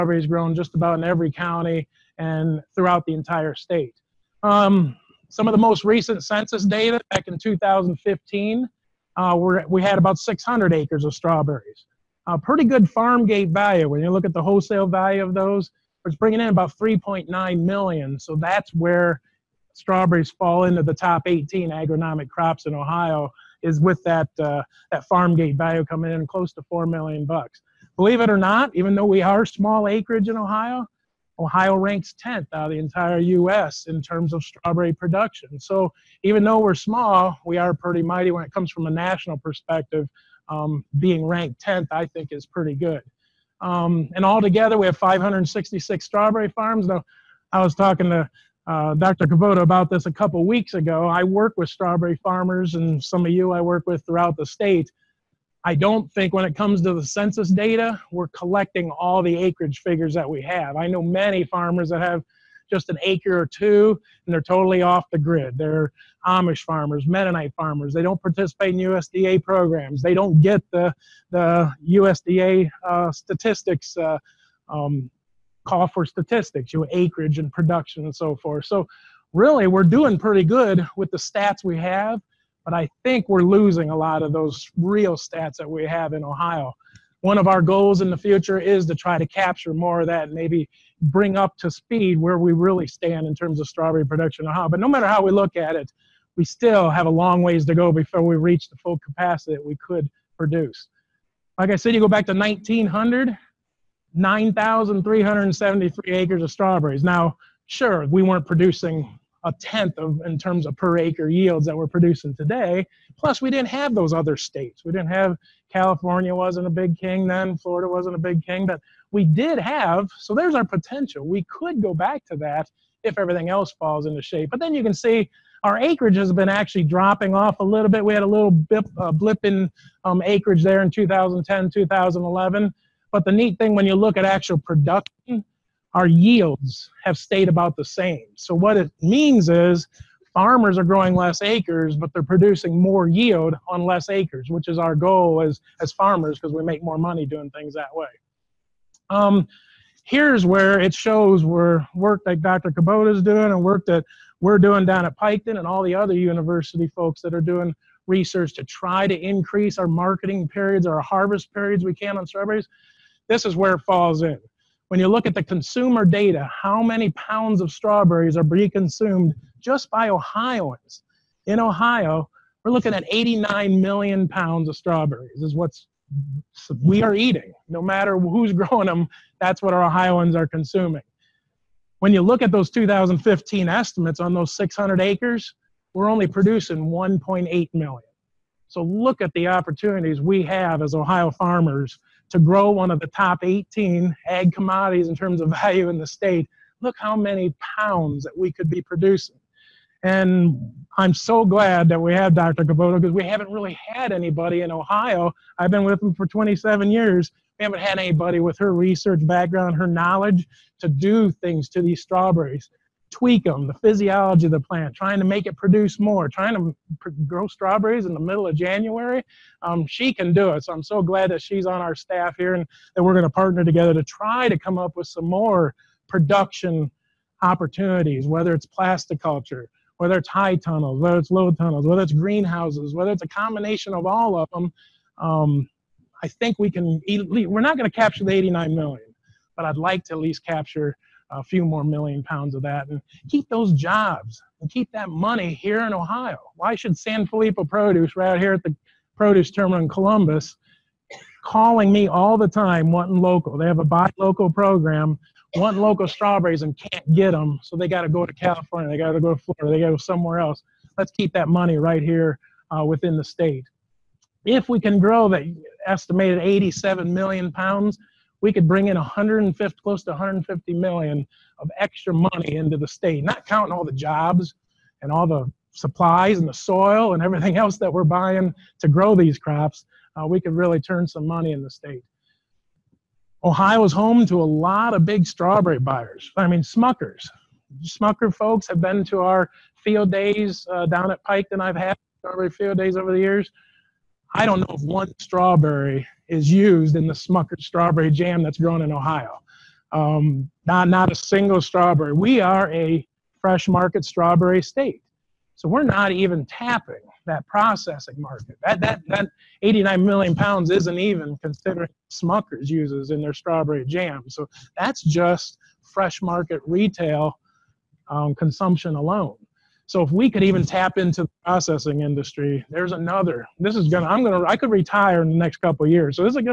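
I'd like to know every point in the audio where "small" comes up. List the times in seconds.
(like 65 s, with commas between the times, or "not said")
29 s, 36 s.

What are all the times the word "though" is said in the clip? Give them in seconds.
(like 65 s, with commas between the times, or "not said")
28 s, 36 s.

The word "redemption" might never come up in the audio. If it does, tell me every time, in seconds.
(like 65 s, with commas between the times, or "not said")
not said.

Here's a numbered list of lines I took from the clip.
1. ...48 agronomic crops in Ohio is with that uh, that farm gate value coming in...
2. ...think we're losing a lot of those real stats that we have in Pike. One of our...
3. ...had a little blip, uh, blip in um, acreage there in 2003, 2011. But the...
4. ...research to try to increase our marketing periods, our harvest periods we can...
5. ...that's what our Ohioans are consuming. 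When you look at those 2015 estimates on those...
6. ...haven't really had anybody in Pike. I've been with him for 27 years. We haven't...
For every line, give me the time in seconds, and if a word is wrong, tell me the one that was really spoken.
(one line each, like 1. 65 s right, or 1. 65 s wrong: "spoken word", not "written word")
1. 21 s wrong: "18", not "48"
2. 83 s wrong: "Ohio", not "Pike"
3. 128 s wrong: "2010", not "2003"
4. 158 s right
5. 179 s right
6. 203 s wrong: "Ohio", not "Pike".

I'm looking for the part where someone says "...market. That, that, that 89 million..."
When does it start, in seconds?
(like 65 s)
308 s.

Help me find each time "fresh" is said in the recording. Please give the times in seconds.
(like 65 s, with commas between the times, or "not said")
303 s, 315 s.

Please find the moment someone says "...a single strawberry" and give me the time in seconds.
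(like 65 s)
301 s.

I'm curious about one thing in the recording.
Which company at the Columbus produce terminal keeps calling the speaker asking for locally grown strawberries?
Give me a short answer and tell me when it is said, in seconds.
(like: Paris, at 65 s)
San Filippo Produce, at 246 s.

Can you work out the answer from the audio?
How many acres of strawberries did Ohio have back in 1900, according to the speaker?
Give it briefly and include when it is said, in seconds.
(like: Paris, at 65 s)
9,373, at 104 s.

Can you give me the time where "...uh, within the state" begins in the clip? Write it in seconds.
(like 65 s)
262 s.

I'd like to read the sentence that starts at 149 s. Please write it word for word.
Um, here's where it shows where work that Dr.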